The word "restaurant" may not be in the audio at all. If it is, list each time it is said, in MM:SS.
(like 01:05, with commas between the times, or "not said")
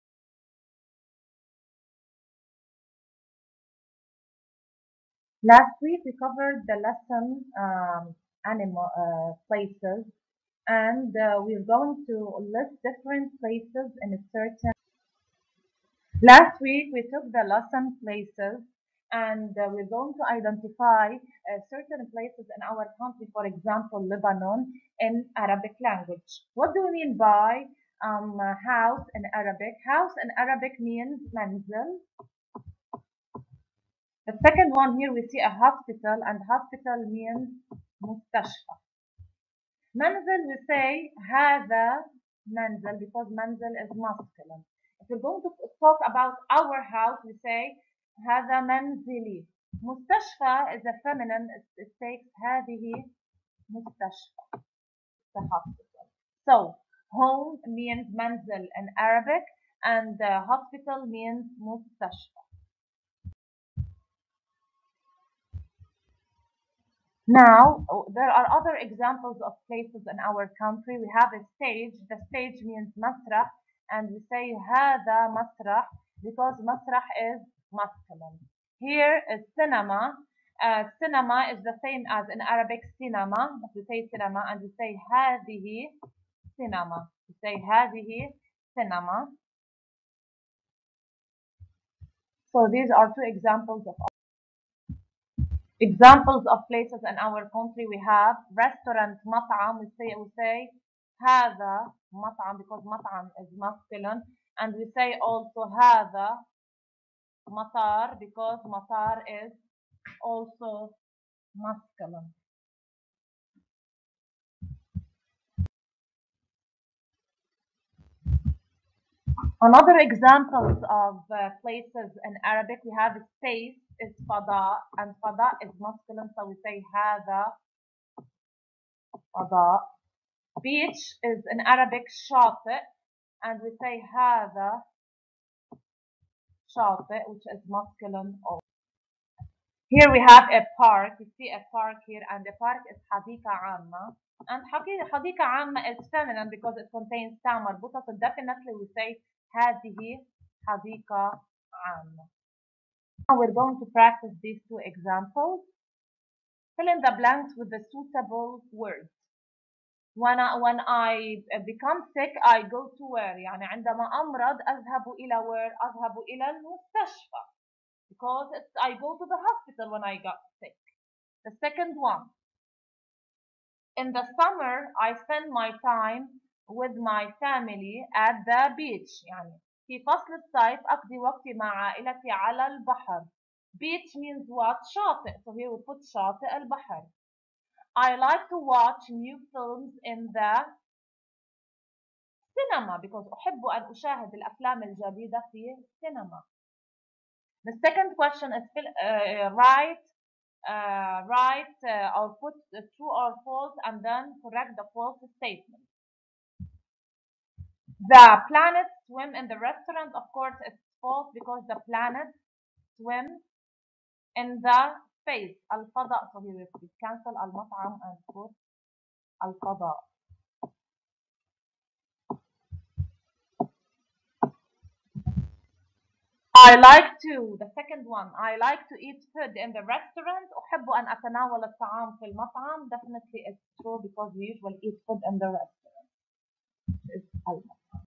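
01:38, 03:29, 03:49, 03:55.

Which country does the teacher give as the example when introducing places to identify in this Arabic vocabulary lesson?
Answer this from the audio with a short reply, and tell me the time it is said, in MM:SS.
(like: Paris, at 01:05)
Lebanon, at 00:24.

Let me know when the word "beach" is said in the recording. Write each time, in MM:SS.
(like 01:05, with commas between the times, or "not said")
02:10, 02:58, 03:03.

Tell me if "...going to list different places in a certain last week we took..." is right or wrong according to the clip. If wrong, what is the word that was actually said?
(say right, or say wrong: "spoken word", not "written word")
right.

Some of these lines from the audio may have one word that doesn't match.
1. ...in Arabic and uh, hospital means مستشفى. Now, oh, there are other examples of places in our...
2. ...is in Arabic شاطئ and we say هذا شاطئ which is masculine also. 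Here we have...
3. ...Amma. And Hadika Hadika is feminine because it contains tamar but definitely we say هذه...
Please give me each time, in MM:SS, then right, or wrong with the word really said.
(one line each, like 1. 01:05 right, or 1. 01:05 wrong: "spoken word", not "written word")
1. 00:58 right
2. 02:11 right
3. 02:23 wrong: "Amma", not "Hadika".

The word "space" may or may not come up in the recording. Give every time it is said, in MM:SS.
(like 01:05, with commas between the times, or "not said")
02:03, 03:35.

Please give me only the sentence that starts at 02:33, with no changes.
Now we're going to practice these two examples.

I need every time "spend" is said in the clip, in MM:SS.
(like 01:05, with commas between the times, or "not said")
02:55.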